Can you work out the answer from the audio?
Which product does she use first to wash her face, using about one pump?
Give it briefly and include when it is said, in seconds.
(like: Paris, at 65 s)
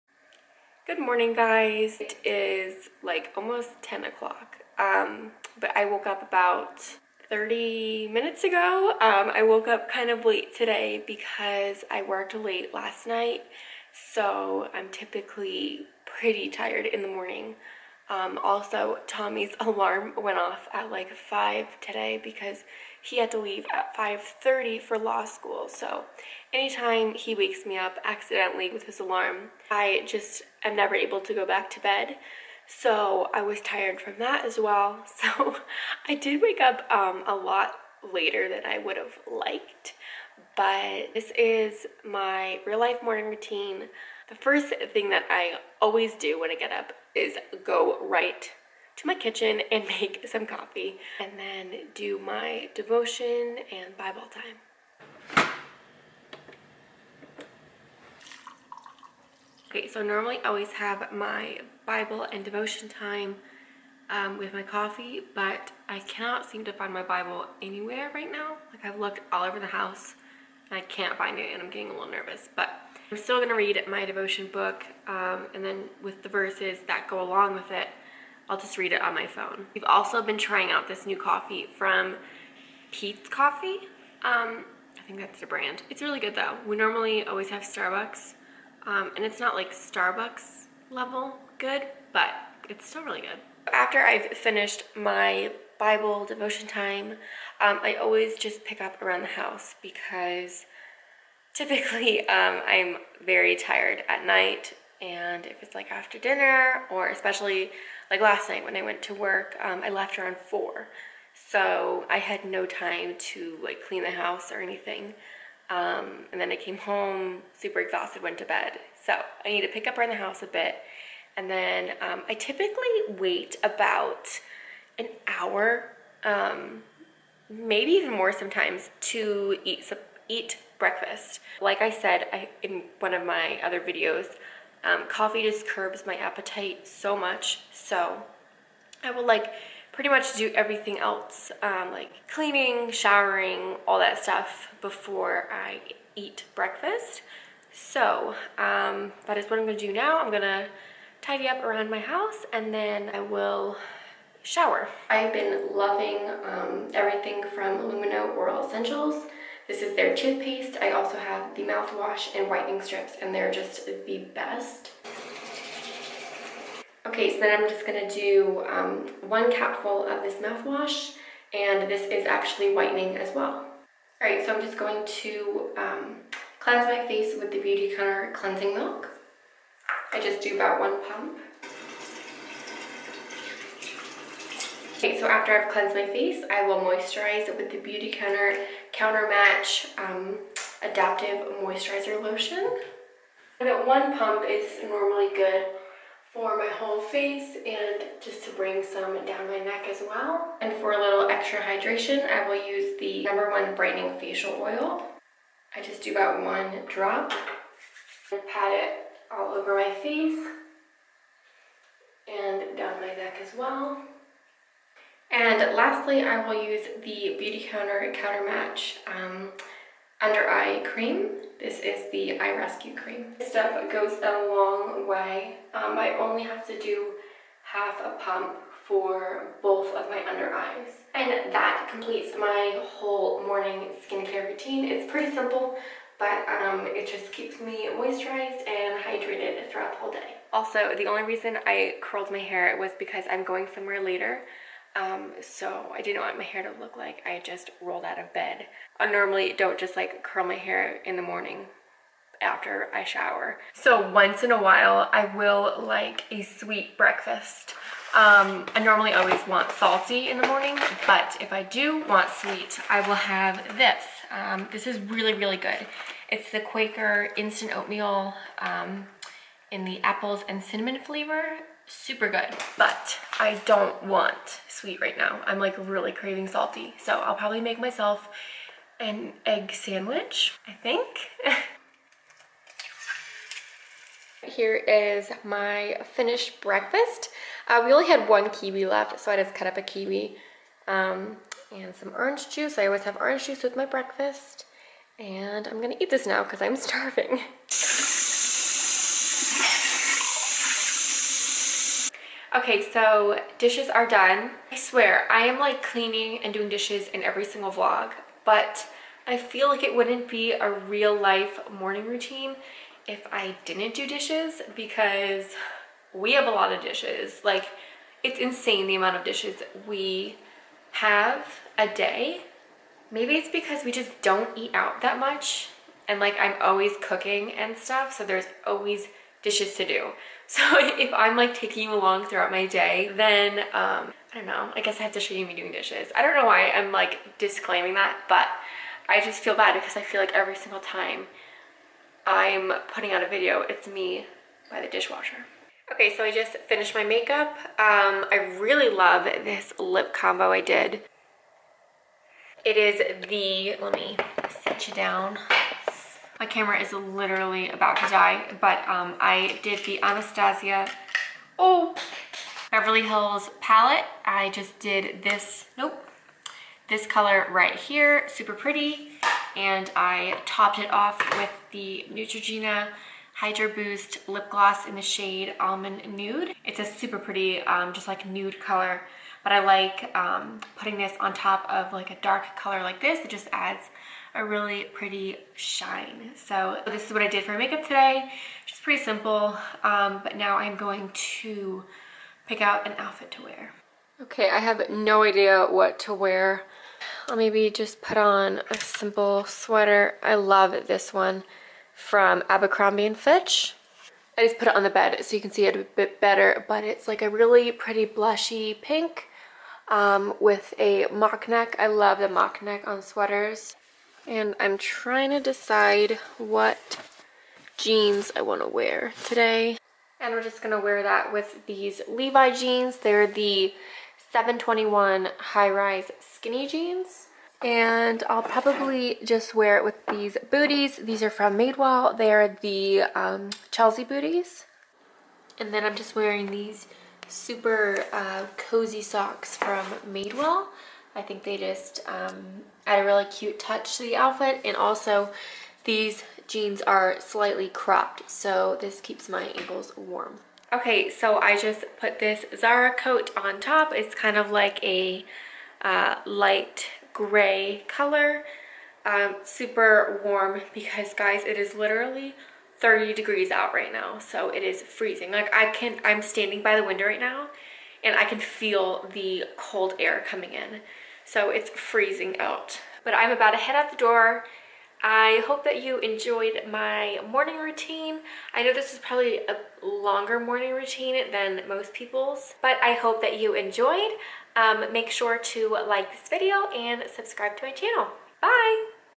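Beautycounter Cleansing Milk, at 177 s.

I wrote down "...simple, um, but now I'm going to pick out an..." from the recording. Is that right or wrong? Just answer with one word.
right.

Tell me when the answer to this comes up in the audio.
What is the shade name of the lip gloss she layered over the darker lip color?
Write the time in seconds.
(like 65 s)
375 s.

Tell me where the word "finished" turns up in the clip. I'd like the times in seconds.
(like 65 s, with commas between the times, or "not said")
94 s, 286 s, 346 s.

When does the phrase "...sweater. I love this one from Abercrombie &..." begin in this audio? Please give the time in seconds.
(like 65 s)
399 s.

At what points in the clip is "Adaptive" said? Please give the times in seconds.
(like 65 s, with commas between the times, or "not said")
190 s.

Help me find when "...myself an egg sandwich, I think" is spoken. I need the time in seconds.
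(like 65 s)
277 s.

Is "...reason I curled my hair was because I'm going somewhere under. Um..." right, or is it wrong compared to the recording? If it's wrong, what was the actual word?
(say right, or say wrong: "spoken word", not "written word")
wrong: "later", not "under".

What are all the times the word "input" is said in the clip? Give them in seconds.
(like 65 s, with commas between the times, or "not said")
not said.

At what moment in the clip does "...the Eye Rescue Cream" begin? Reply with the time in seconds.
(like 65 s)
222 s.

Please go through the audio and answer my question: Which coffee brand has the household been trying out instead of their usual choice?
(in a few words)
Peet's Coffee.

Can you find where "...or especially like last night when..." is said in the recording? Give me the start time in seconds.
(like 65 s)
106 s.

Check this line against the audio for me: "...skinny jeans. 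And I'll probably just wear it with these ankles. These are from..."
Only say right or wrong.
wrong.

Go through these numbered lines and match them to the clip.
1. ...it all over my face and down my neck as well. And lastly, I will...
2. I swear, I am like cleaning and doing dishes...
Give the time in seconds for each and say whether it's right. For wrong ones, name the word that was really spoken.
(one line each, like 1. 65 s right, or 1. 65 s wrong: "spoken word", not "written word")
1. 208 s right
2. 304 s right.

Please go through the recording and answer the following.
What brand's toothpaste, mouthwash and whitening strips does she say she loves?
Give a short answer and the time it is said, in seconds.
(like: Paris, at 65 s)
Lumineux Oral Essentials, at 157 s.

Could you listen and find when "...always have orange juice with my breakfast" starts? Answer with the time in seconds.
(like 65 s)
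292 s.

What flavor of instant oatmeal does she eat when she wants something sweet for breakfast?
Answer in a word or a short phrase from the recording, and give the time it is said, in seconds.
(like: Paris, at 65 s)
apples and cinnamon, at 270 s.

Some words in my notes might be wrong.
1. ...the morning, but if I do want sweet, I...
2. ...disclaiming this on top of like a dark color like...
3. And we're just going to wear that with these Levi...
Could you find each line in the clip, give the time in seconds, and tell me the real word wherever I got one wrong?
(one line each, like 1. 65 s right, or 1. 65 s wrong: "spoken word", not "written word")
1. 260 s right
2. 380 s wrong: "putting", not "disclaiming"
3. 420 s right.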